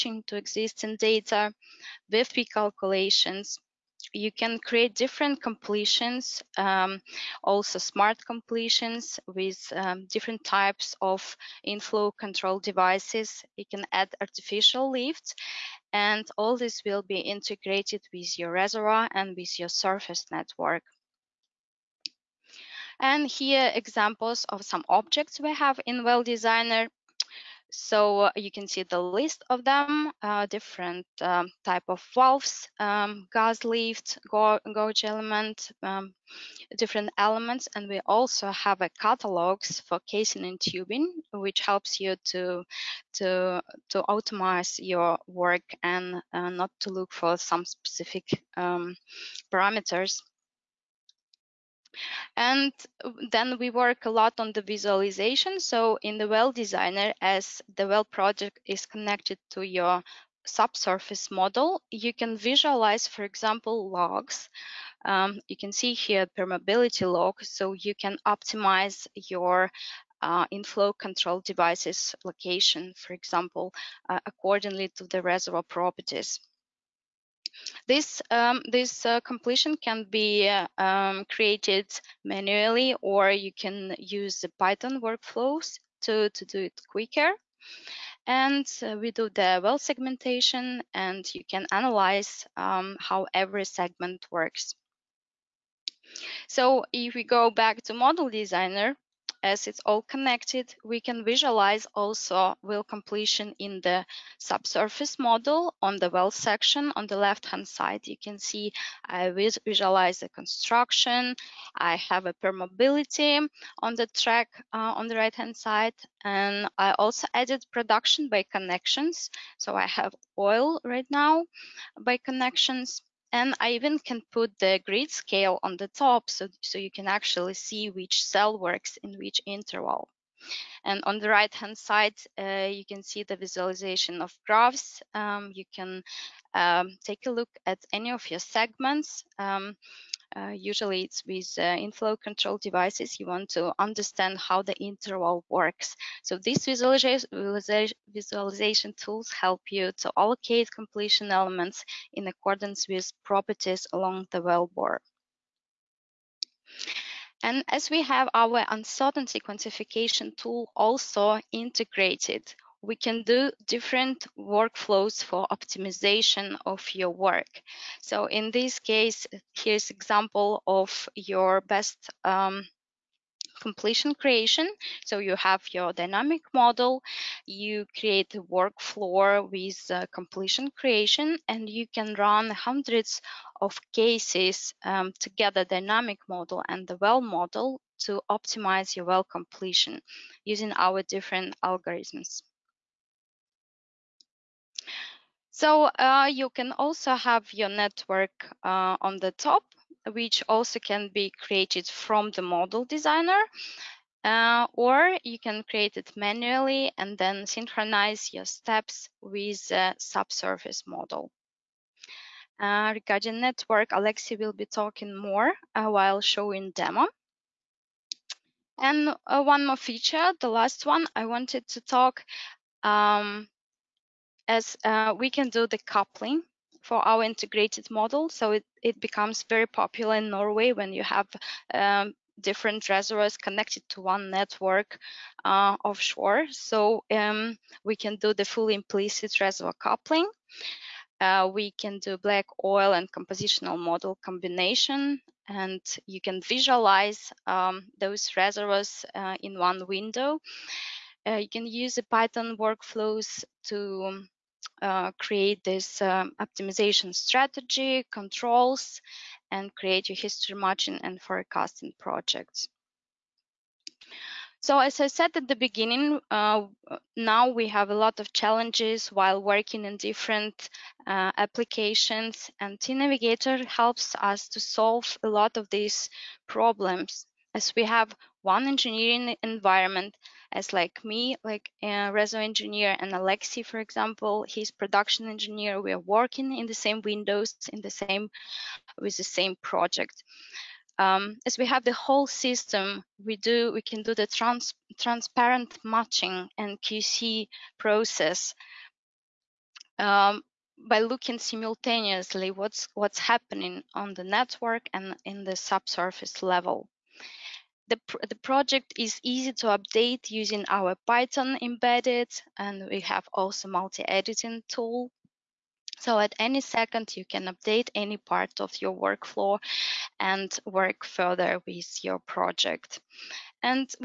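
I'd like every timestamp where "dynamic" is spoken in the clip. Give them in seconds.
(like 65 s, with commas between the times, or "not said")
175 s, 185 s.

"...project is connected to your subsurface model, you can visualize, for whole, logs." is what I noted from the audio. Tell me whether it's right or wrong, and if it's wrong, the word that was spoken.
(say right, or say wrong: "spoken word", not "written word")
wrong: "example", not "whole".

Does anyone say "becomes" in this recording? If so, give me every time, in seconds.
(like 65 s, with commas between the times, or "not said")
228 s.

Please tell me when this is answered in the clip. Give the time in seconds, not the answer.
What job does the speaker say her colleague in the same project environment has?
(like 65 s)
284 s.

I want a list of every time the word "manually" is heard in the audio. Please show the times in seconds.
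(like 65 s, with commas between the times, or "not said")
82 s, 206 s.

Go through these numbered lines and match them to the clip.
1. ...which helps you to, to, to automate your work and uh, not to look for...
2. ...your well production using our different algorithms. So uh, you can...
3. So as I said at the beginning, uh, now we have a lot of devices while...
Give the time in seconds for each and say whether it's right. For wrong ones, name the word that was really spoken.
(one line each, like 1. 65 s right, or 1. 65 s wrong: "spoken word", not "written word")
1. 41 s right
2. 188 s wrong: "completion", not "production"
3. 264 s wrong: "challenges", not "devices".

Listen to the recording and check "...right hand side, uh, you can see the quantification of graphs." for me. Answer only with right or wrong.
wrong.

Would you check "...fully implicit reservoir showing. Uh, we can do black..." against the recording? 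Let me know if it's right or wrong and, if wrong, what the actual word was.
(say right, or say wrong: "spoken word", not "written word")
wrong: "coupling", not "showing".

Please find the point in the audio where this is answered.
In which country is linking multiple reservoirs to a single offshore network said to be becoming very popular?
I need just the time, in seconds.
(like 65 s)
230 s.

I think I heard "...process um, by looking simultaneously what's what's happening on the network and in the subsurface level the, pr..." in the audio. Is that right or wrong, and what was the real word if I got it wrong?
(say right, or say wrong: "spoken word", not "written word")
right.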